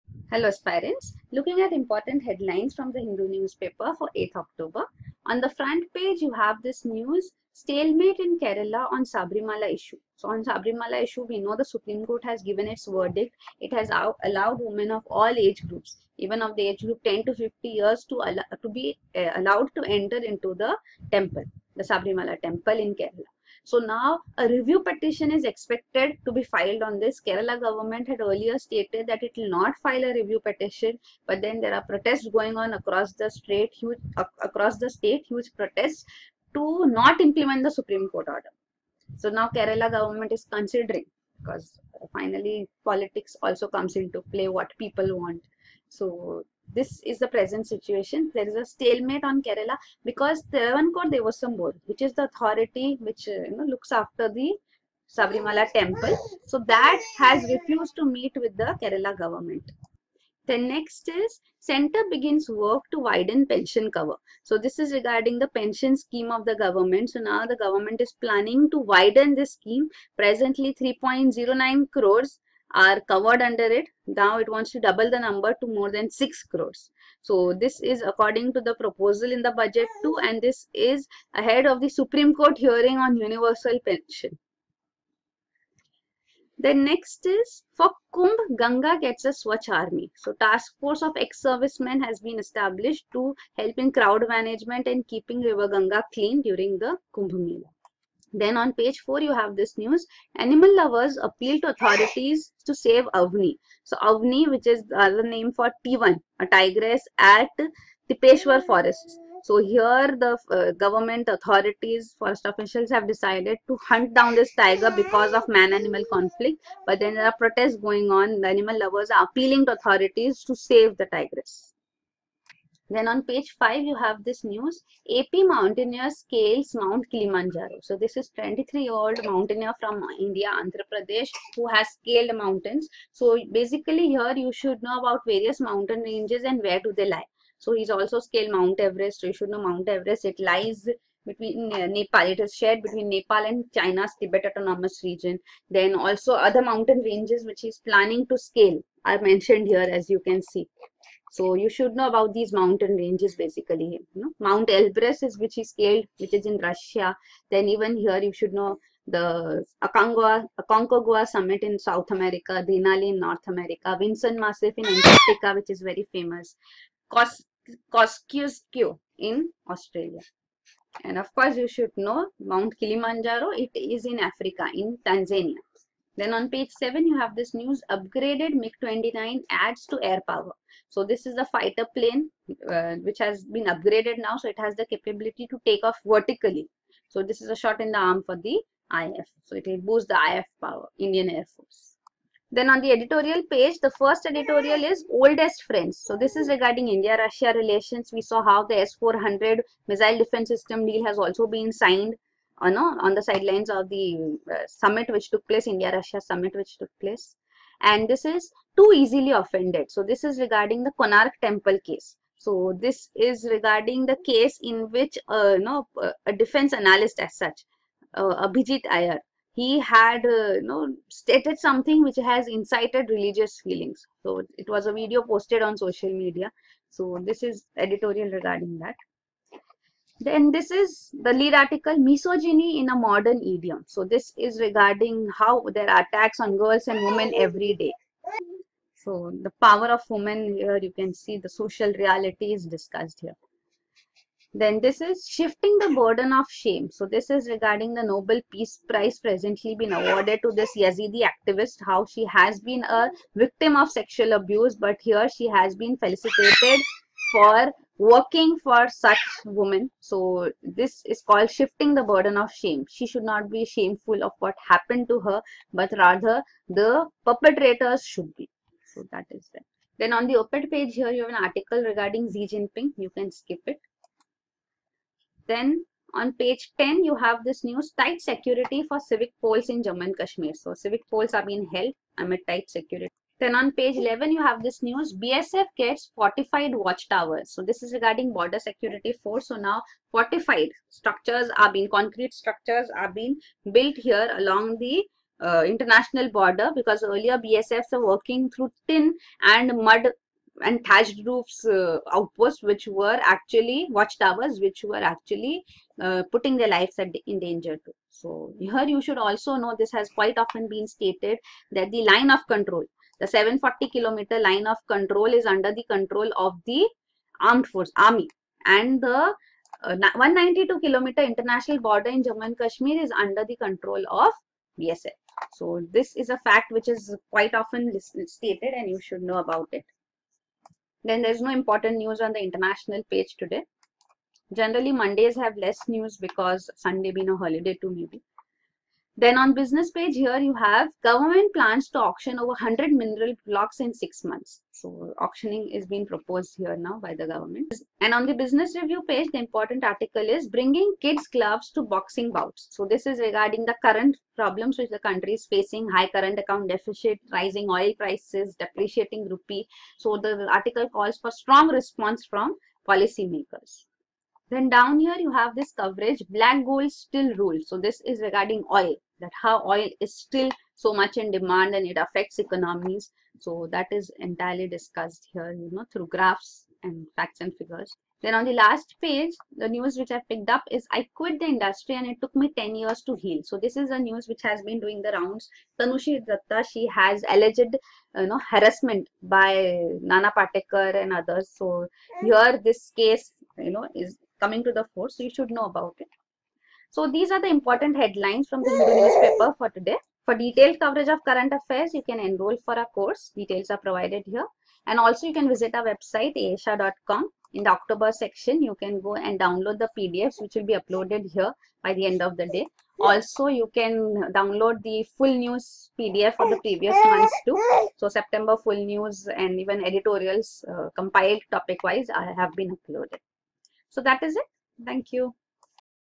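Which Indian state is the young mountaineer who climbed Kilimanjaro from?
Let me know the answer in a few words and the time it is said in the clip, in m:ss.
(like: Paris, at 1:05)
Andhra Pradesh, at 2:10.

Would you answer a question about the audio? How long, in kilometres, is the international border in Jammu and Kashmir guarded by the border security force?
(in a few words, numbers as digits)
192 kilometres.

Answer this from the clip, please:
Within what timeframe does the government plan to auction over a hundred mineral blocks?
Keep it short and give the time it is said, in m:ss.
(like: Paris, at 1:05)
6 months, at 5:43.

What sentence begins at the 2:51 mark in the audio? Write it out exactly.
And of course you should know Mount Kilimanjaro, it is in Africa, in Tanzania.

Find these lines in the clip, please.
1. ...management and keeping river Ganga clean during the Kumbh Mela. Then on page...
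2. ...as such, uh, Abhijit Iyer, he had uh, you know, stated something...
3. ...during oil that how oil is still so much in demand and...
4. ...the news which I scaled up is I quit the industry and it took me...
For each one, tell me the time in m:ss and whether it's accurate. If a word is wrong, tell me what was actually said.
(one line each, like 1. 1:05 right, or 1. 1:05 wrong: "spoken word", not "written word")
1. 1:34 right
2. 3:37 right
3. 6:08 wrong: "regarding", not "during"
4. 6:19 wrong: "picked", not "scaled".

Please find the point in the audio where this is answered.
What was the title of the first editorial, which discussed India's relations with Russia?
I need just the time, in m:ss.
3:15.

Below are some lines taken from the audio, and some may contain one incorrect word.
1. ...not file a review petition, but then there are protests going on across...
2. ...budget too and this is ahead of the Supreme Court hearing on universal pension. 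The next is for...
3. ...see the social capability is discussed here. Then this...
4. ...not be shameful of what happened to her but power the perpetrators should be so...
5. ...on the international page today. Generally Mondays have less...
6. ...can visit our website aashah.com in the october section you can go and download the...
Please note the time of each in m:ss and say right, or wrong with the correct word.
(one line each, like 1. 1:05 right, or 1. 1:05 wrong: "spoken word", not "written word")
1. 0:29 right
2. 1:19 right
3. 4:01 wrong: "reality", not "capability"
4. 4:23 wrong: "rather", not "power"
5. 5:32 right
6. 6:45 right.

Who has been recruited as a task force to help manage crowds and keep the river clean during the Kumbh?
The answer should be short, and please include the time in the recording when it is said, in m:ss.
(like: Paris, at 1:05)
Ex-servicemen, at 1:31.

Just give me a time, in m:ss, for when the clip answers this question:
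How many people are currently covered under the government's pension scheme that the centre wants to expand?
1:10.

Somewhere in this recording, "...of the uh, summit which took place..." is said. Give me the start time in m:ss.
3:23.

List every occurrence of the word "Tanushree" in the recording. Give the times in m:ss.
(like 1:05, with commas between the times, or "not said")
6:25.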